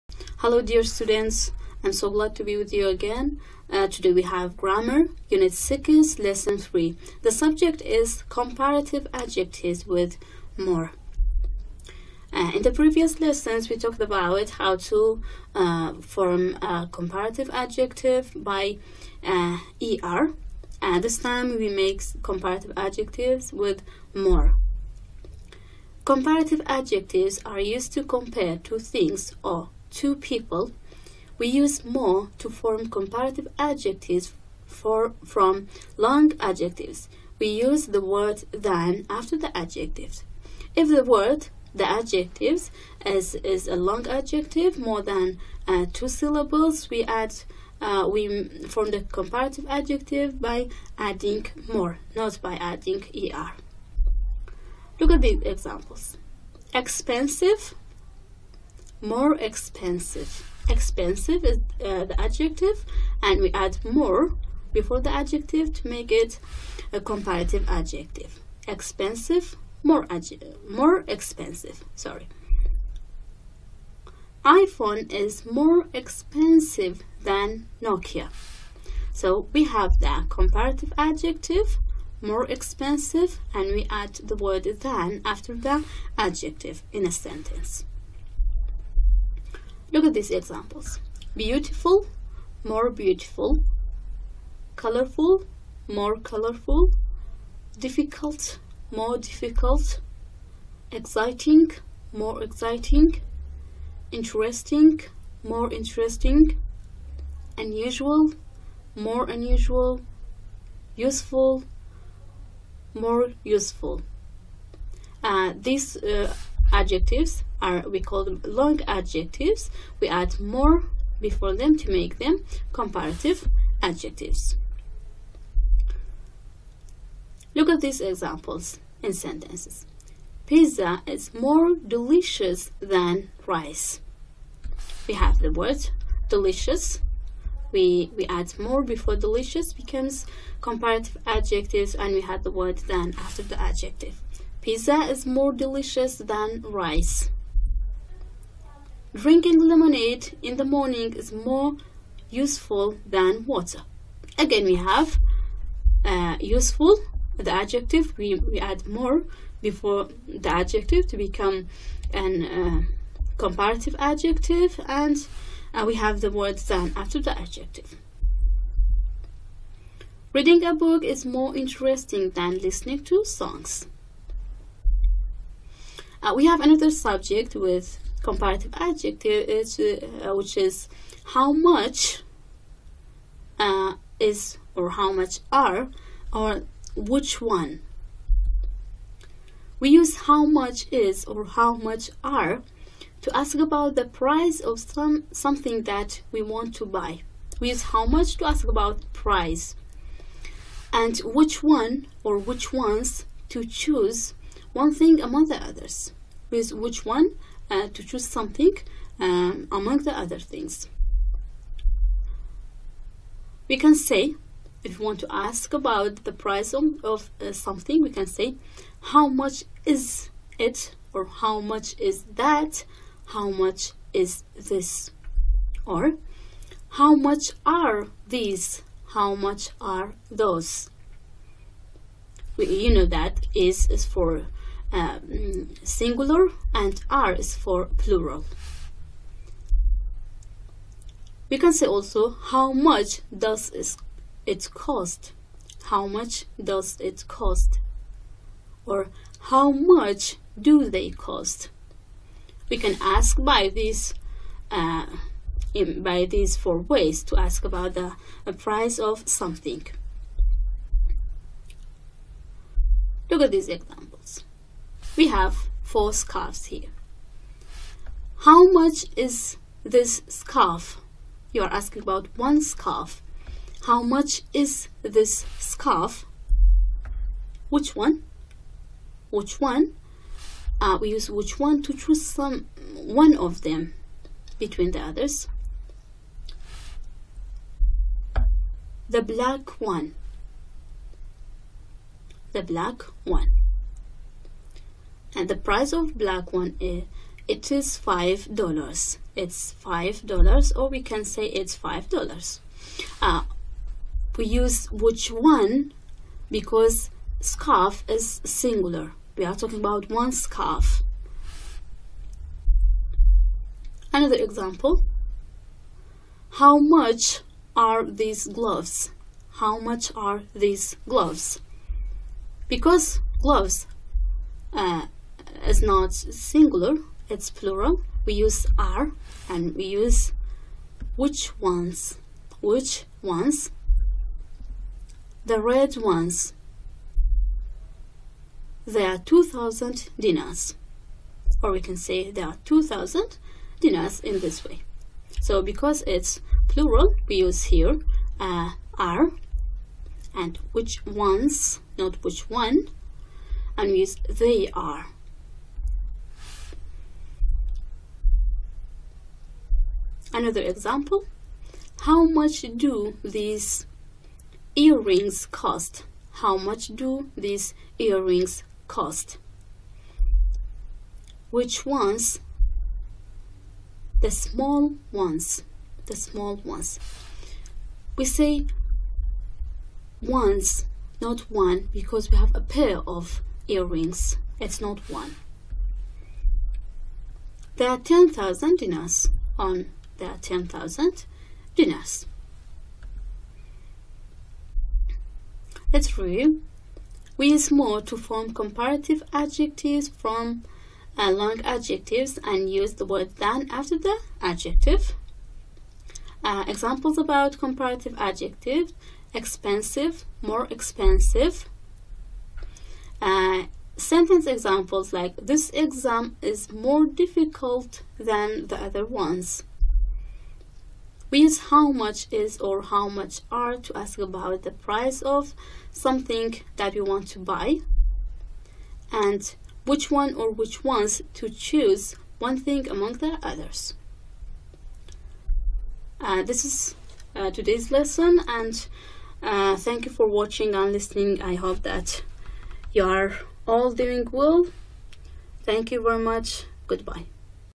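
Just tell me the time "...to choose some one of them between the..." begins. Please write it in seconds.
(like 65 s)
281 s.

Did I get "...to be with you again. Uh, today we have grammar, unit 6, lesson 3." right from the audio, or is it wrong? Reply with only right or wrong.
right.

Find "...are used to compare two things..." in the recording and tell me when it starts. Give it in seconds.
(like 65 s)
27 s.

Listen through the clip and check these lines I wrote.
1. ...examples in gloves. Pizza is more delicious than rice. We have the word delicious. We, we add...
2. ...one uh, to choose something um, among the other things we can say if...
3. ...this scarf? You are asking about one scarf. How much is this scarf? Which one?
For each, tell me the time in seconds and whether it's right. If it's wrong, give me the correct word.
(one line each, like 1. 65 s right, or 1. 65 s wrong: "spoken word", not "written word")
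1. 128 s wrong: "sentences", not "gloves"
2. 207 s right
3. 269 s right.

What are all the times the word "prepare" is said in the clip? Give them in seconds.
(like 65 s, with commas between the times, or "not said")
not said.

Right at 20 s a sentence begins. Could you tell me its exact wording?
And uh, this time we make comparative adjectives with more.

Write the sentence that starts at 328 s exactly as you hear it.
We use are and we use which ones, which ones, the red ones.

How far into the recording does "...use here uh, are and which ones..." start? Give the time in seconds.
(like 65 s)
347 s.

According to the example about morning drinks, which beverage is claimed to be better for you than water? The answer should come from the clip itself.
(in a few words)
Lemonade.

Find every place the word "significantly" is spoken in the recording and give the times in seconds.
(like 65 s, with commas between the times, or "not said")
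not said.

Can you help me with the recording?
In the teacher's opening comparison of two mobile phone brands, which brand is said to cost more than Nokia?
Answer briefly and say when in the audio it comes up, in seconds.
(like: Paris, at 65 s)
iPhone, at 74 s.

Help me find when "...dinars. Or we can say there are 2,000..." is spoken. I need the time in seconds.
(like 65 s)
340 s.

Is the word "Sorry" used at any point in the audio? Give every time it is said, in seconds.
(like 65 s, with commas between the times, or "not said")
71 s.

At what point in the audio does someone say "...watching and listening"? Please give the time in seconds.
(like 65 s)
440 s.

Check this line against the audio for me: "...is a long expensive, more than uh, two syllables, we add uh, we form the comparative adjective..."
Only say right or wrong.
wrong.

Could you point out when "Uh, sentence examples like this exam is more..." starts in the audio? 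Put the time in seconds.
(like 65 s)
413 s.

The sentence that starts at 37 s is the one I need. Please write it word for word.
We use the word than after the adjectives.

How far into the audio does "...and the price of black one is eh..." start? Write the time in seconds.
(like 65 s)
295 s.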